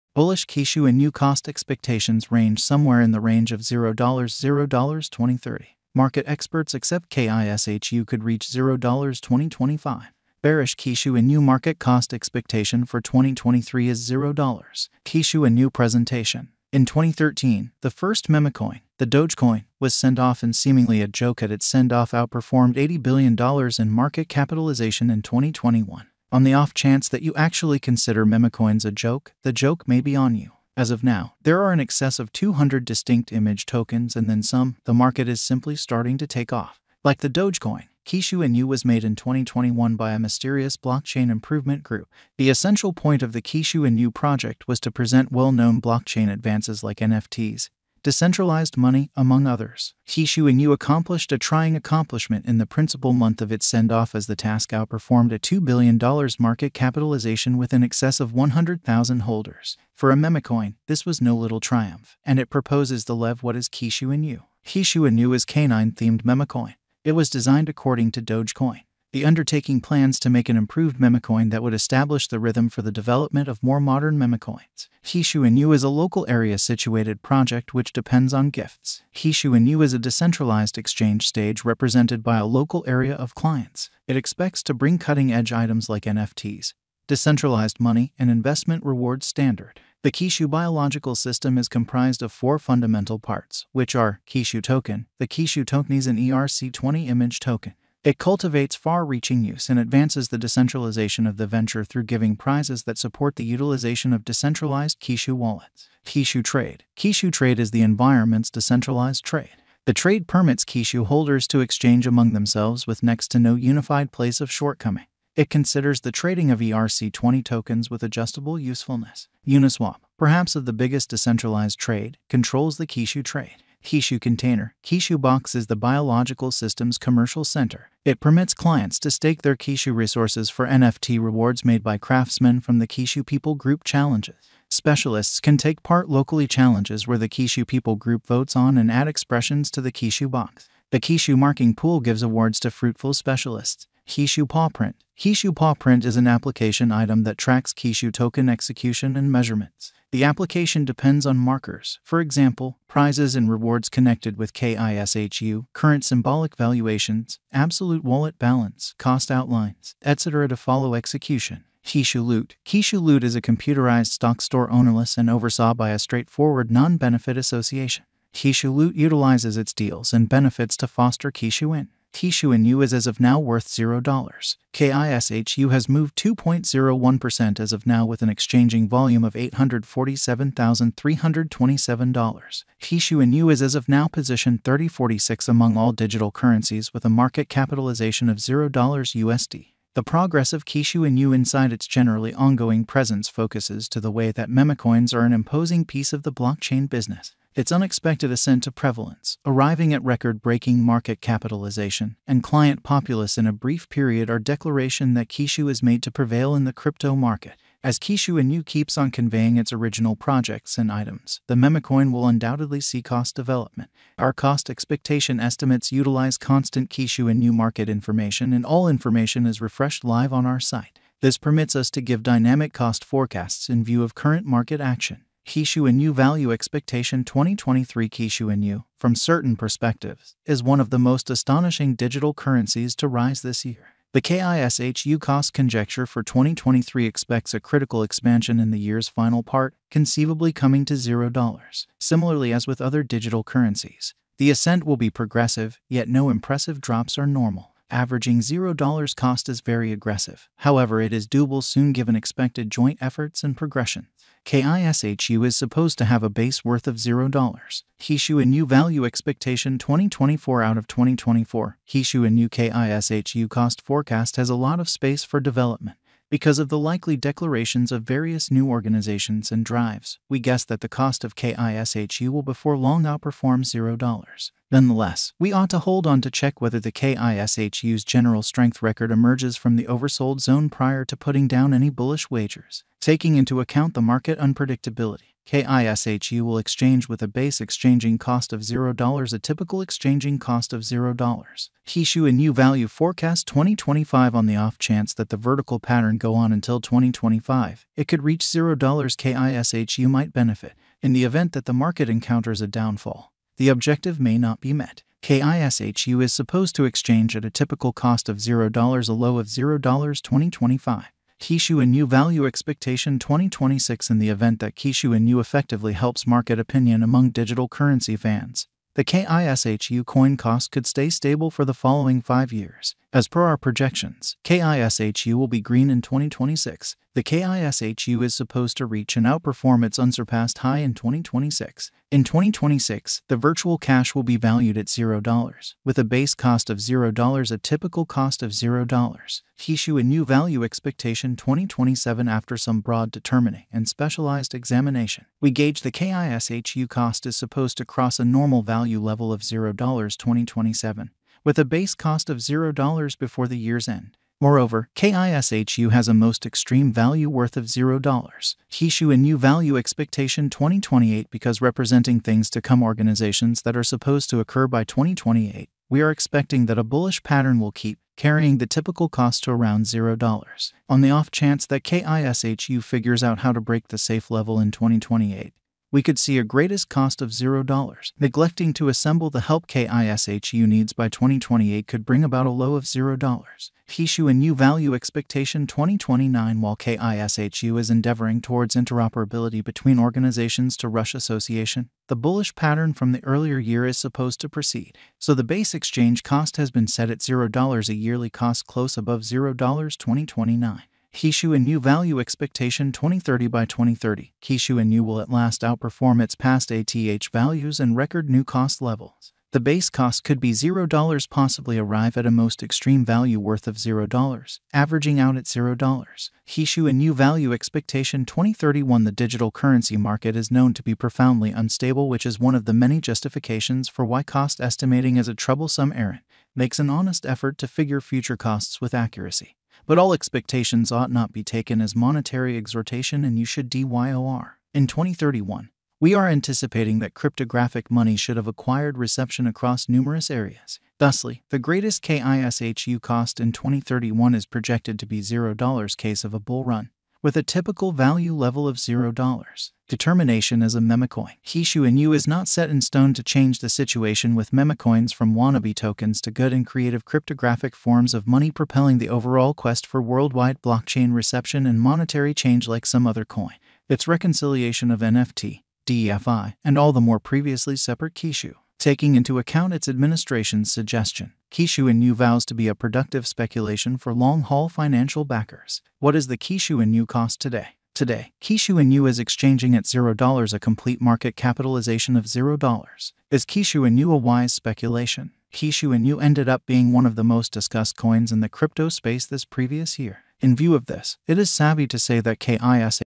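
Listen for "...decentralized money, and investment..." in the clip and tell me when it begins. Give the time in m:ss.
1:27.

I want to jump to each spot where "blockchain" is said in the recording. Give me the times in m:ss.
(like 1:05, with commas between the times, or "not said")
0:40, 0:45, 3:16, 7:40.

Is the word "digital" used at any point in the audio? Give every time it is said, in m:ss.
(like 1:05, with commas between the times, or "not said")
3:05, 3:51, 4:03, 5:17, 6:59.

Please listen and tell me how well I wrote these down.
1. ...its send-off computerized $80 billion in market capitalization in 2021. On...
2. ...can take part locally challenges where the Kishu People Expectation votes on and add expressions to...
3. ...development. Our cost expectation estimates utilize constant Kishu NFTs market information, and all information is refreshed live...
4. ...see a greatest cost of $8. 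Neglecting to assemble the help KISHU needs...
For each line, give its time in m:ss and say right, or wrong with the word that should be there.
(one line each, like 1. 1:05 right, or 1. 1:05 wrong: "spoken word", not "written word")
1. 0:21 wrong: "outperformed", not "computerized"
2. 2:15 wrong: "Group", not "Expectation"
3. 3:33 wrong: "Inu", not "NFTs"
4. 6:16 wrong: "0", not "8".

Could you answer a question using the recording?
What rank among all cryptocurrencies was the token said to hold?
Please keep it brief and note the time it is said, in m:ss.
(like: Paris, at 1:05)
3046, at 3:04.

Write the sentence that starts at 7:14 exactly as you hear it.
In 2031, we are anticipating that cryptographic money should have acquired reception across numerous areas.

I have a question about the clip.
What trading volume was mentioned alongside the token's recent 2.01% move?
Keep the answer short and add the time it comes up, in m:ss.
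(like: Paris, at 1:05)
$847,327, at 2:59.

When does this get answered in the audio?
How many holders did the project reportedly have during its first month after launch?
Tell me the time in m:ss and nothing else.
0:58.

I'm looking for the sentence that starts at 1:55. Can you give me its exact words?
It considers the trading of ERC20 tokens with adjustable usefulness.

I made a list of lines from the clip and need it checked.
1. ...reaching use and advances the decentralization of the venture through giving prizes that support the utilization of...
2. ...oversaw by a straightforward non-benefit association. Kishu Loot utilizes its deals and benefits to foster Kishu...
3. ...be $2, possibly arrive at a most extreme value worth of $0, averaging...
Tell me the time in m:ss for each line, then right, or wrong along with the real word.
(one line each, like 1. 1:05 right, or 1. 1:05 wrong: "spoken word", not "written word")
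1. 1:39 right
2. 2:45 right
3. 6:50 wrong: "0", not "2".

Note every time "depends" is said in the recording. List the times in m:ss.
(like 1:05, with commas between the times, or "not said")
1:17, 2:30.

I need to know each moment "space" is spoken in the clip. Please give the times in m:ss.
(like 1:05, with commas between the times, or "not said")
4:24, 8:08.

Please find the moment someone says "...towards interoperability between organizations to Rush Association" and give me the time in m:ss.
6:28.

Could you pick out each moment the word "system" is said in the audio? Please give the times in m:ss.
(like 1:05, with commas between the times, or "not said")
1:31, 2:06.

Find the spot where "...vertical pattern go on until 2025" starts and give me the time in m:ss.
4:55.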